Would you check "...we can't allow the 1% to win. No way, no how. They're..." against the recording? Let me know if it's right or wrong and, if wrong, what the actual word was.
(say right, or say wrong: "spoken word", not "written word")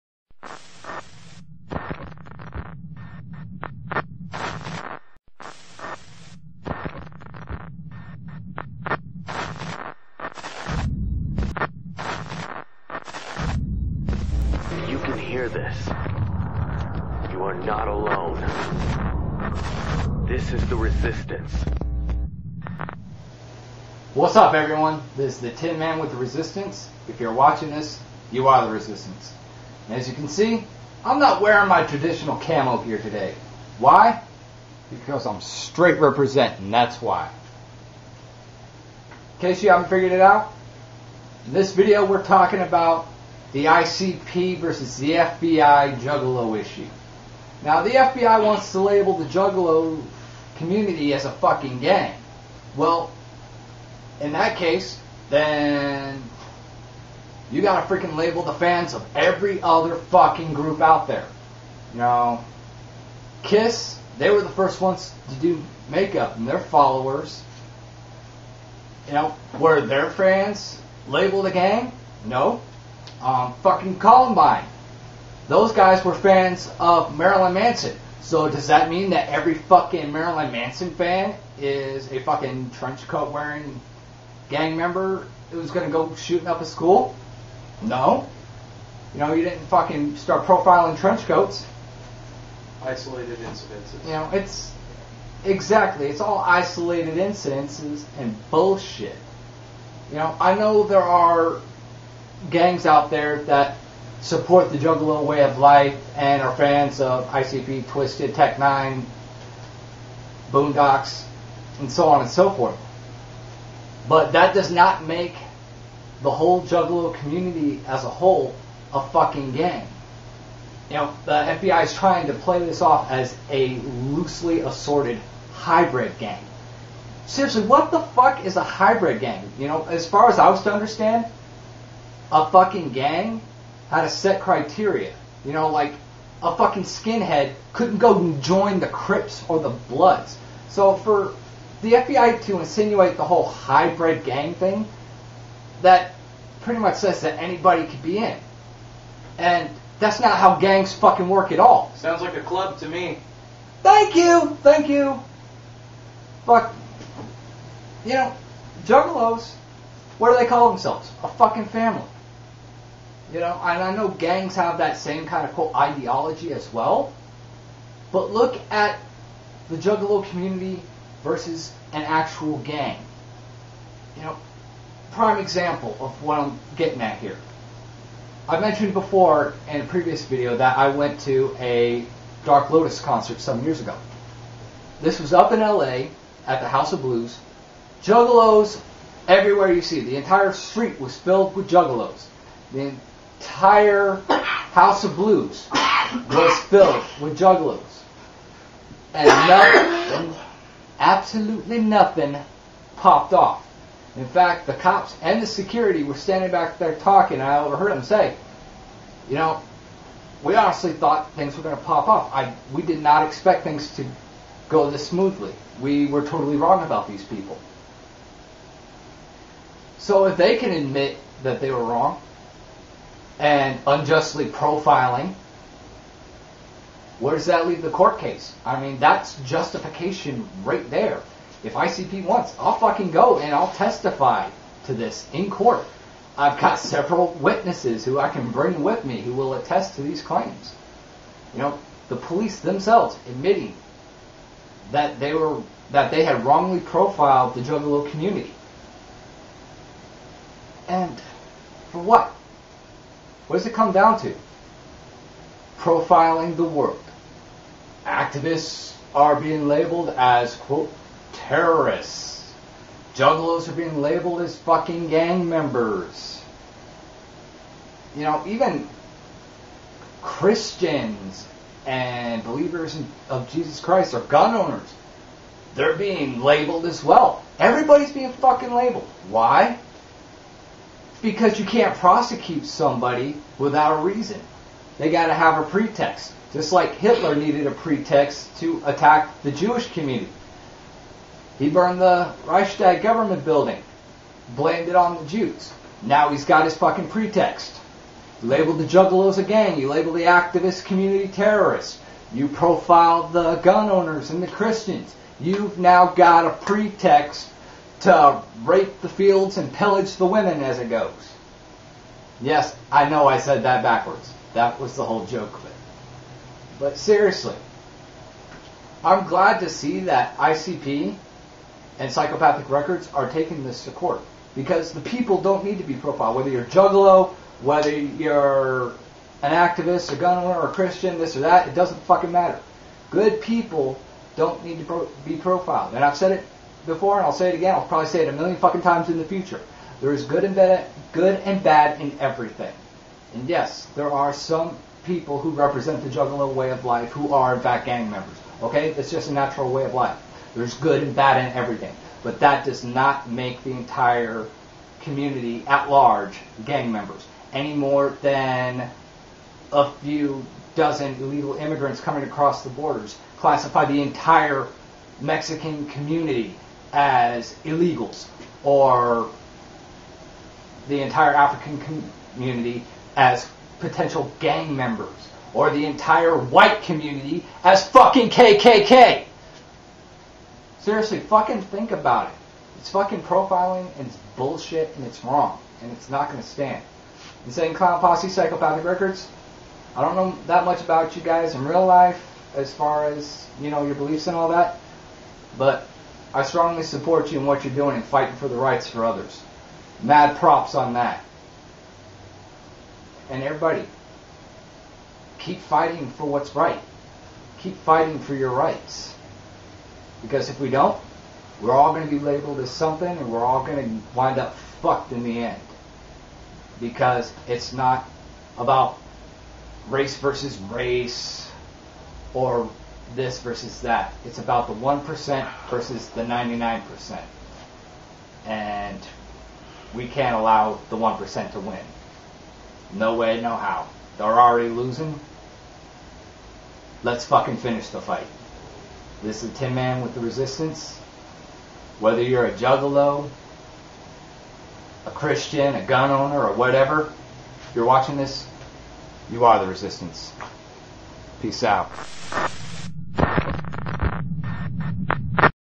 right.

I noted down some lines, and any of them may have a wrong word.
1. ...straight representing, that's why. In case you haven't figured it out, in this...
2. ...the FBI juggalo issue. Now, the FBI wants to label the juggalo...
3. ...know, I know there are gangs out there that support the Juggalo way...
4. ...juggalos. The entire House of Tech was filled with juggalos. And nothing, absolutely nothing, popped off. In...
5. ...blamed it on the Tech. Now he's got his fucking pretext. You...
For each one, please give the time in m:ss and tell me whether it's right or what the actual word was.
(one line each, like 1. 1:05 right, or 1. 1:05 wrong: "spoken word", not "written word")
1. 0:35 right
2. 0:44 right
3. 1:40 right
4. 3:11 wrong: "Blues", not "Tech"
5. 4:54 wrong: "Jews", not "Tech".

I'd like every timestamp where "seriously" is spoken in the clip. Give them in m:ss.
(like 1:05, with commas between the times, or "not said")
2:07, 5:16, 6:20.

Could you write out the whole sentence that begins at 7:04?
It's about the 1% versus the 99%.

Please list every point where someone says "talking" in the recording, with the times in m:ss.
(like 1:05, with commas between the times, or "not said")
0:42, 3:26.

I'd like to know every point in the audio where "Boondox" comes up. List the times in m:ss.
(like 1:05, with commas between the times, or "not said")
1:50.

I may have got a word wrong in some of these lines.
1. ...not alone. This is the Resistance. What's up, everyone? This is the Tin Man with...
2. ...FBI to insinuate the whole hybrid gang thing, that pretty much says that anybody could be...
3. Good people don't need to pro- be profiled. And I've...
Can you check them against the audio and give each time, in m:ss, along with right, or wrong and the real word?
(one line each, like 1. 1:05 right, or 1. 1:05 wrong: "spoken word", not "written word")
1. 0:17 right
2. 2:21 right
3. 5:33 right.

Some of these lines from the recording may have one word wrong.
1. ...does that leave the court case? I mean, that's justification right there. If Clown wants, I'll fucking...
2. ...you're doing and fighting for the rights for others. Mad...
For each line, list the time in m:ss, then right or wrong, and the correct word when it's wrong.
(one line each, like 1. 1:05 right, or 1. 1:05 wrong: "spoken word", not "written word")
1. 3:47 wrong: "ICP", not "Clown"
2. 6:37 right.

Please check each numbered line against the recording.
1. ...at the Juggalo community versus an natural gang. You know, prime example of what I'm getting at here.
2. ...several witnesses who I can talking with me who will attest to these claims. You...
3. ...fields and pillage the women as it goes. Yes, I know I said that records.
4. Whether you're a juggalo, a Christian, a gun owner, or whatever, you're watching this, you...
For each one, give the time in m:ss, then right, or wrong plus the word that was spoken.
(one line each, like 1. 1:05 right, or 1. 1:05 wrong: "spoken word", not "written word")
1. 2:48 wrong: "actual", not "natural"
2. 3:56 wrong: "bring", not "talking"
3. 5:09 wrong: "backwards", not "records"
4. 7:21 right.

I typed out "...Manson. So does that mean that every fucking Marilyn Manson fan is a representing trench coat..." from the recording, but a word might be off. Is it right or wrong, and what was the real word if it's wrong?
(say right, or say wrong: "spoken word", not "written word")
wrong: "fucking", not "representing".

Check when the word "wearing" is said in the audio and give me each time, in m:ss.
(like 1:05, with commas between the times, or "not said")
0:31, 1:23.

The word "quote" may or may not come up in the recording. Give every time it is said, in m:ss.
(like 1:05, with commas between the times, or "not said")
2:45, 4:20.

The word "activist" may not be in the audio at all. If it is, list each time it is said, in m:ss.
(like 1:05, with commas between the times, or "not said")
4:18, 5:00, 5:29.